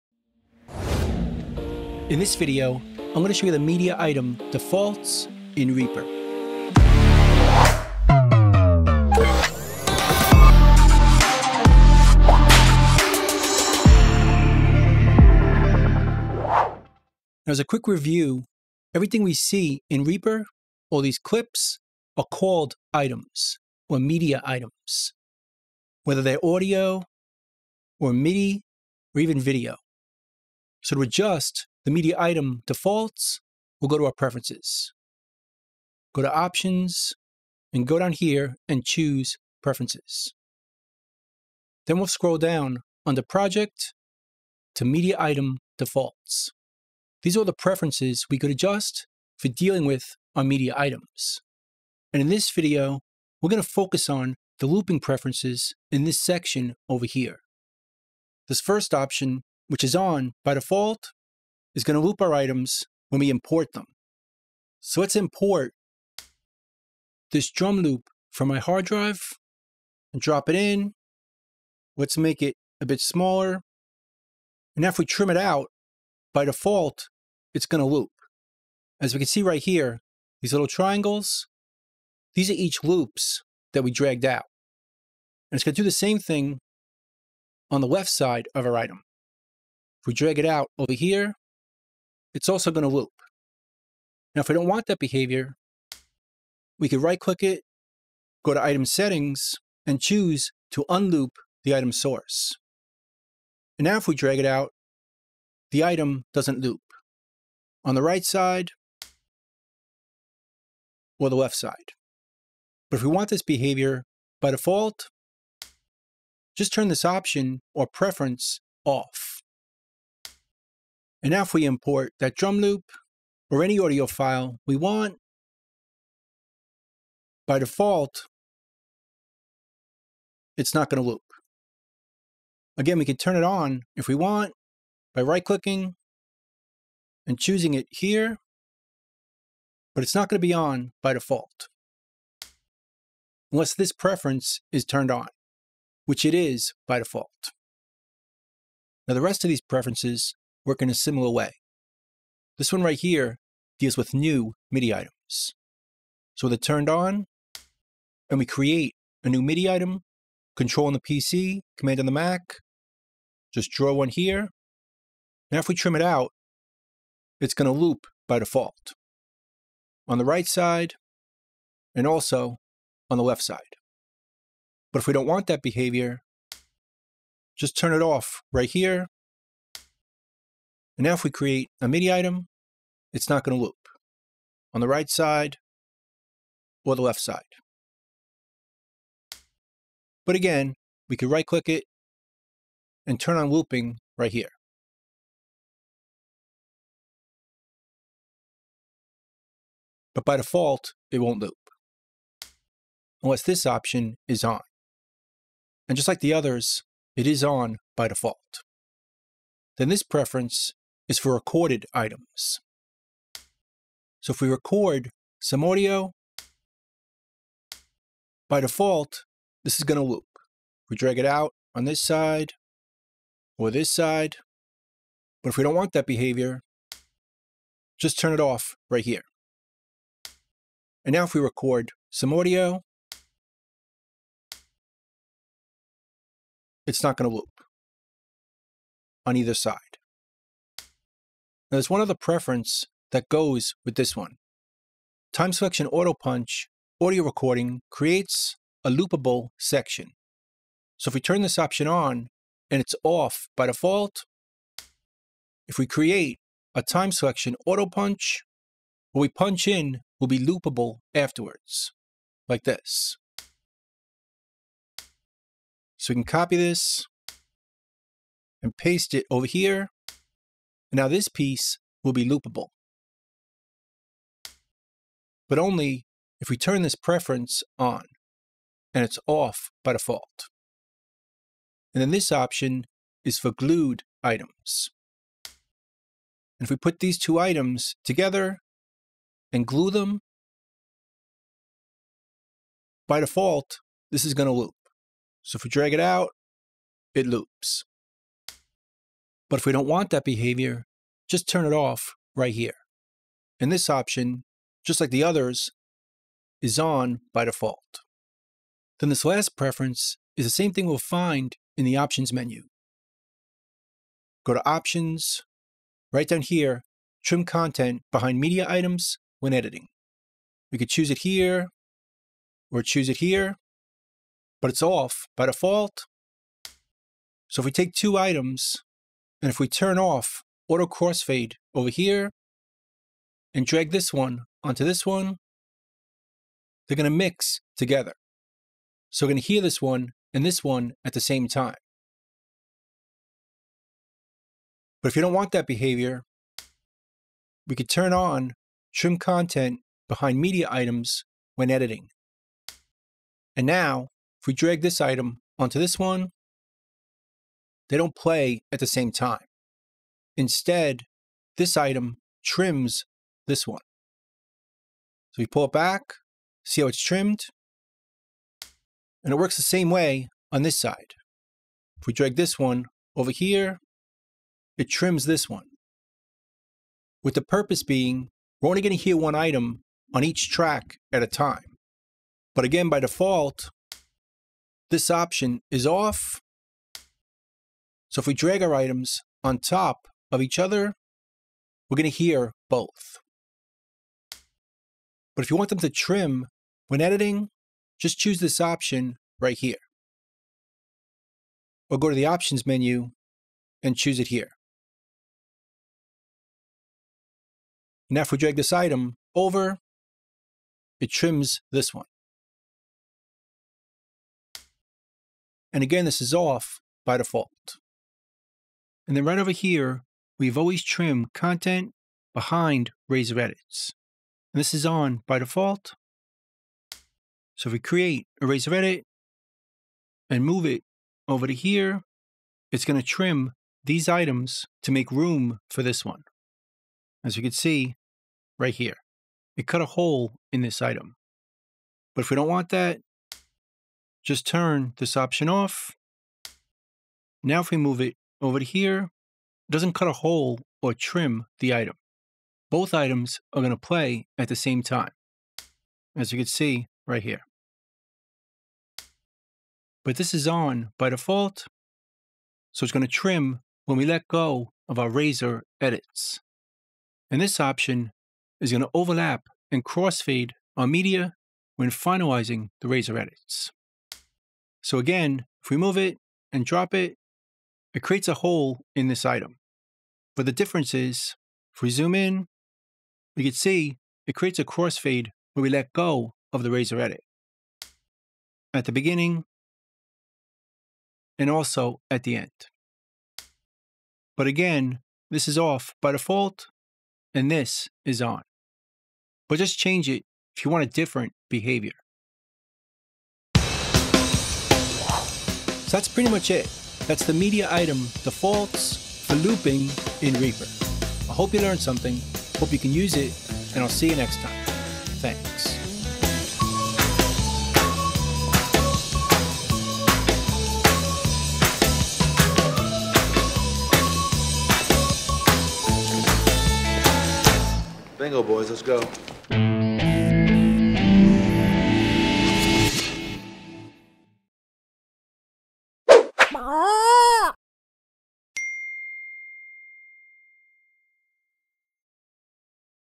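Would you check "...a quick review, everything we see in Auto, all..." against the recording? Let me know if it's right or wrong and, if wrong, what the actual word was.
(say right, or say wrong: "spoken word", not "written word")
wrong: "Reaper", not "Auto".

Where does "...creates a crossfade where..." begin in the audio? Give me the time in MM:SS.
08:04.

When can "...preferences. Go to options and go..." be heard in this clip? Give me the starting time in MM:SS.
00:34.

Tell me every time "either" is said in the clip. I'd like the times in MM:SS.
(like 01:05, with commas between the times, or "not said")
03:59.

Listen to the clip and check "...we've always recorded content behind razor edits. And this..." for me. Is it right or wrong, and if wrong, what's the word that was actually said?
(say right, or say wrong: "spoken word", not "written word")
wrong: "trimmed", not "recorded".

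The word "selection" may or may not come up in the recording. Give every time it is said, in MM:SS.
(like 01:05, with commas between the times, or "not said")
04:05, 04:17.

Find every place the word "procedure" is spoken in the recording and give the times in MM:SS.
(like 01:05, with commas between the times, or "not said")
not said.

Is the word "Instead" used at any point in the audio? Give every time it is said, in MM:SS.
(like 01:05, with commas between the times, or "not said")
06:00.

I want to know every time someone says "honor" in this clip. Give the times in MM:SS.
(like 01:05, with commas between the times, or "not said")
not said.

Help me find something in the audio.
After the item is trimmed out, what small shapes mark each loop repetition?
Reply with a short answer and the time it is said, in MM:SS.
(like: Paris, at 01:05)
Triangles, at 01:20.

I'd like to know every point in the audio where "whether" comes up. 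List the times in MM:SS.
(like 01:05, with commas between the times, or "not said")
00:26.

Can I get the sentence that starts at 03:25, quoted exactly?
And just like the others, it is on by default.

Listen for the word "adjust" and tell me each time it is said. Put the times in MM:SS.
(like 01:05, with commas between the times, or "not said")
00:31, 00:48.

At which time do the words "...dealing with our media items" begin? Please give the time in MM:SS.
00:49.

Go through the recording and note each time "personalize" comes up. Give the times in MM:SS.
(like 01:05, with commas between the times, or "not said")
not said.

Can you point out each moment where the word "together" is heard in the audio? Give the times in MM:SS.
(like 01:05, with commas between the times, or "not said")
04:48, 05:37.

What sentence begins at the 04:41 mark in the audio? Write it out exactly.
And then this option is for glued items.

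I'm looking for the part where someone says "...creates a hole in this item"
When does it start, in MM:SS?
07:58.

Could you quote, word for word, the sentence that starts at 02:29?
Now, the rest of these preferences work in a similar way.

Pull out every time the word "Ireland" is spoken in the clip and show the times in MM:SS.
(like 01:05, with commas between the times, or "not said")
not said.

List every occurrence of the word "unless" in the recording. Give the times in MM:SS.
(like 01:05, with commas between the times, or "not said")
02:23, 03:23.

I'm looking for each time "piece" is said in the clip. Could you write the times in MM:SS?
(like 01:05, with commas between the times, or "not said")
04:31.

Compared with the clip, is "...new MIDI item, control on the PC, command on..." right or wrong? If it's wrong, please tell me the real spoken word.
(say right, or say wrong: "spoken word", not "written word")
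right.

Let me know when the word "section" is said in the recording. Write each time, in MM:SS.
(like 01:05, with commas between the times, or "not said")
00:56, 04:09.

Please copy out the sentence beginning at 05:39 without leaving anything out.
So we're going to hear this one and this one at the same time.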